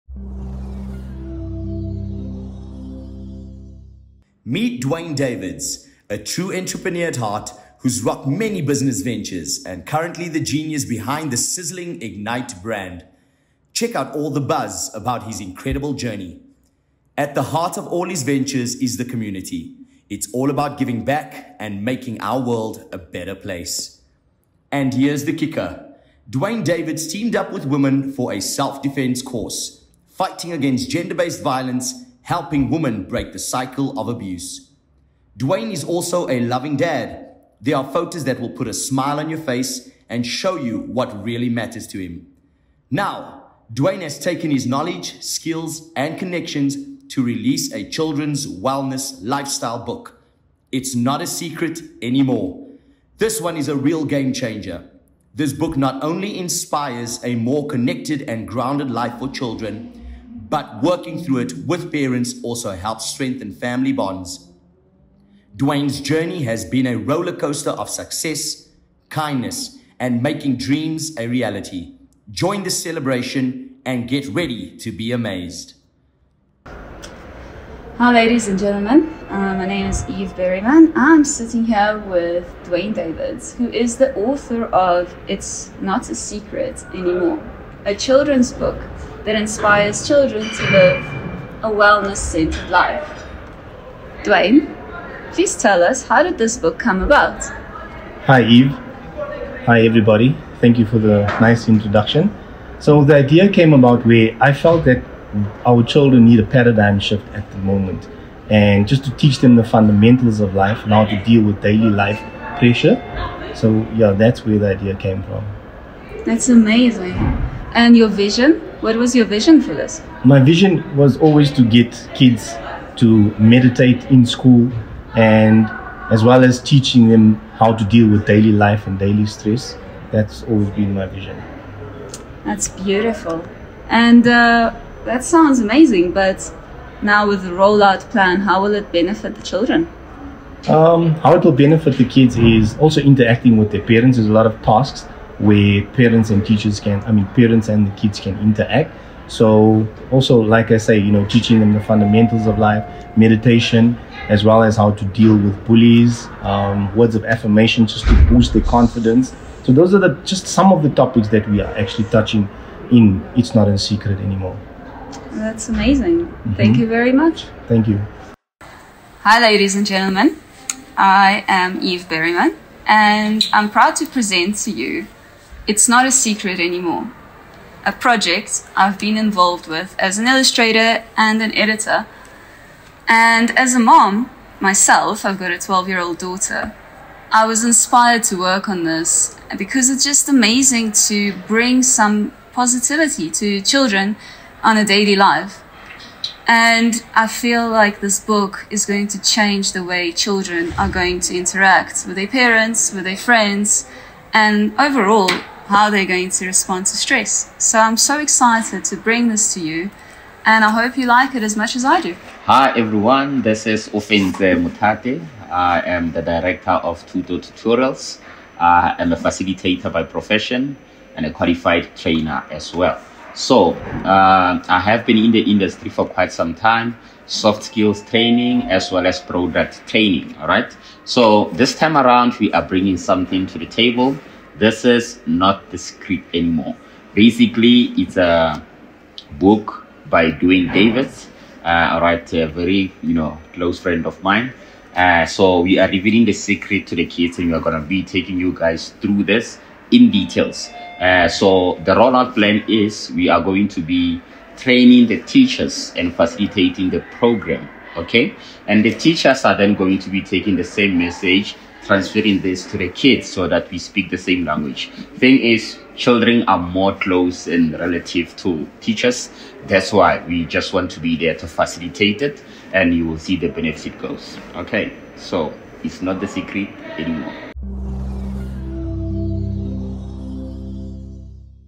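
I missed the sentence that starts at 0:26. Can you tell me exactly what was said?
Duane Davids teamed up with women for a self-defense course, fighting against gender-based violence helping women break the cycle of abuse.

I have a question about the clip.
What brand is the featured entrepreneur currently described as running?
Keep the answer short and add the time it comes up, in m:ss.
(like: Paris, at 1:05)
Ignite, at 0:12.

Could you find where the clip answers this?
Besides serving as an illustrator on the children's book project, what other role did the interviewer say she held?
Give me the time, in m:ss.
3:01.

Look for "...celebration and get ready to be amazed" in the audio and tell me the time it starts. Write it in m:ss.
1:12.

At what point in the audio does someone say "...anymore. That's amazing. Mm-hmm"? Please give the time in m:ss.
2:44.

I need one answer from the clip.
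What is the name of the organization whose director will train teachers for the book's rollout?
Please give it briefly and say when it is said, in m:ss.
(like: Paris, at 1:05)
Tuto Tutorials, at 3:37.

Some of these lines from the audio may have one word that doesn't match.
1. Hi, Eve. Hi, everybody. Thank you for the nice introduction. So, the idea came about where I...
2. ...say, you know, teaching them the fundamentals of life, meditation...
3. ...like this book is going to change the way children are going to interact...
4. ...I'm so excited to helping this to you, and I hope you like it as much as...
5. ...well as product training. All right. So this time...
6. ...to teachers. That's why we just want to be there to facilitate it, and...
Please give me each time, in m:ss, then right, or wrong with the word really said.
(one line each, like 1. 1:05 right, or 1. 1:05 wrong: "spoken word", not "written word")
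1. 1:38 right
2. 2:30 right
3. 3:17 right
4. 3:27 wrong: "bring", not "helping"
5. 3:48 right
6. 4:28 right.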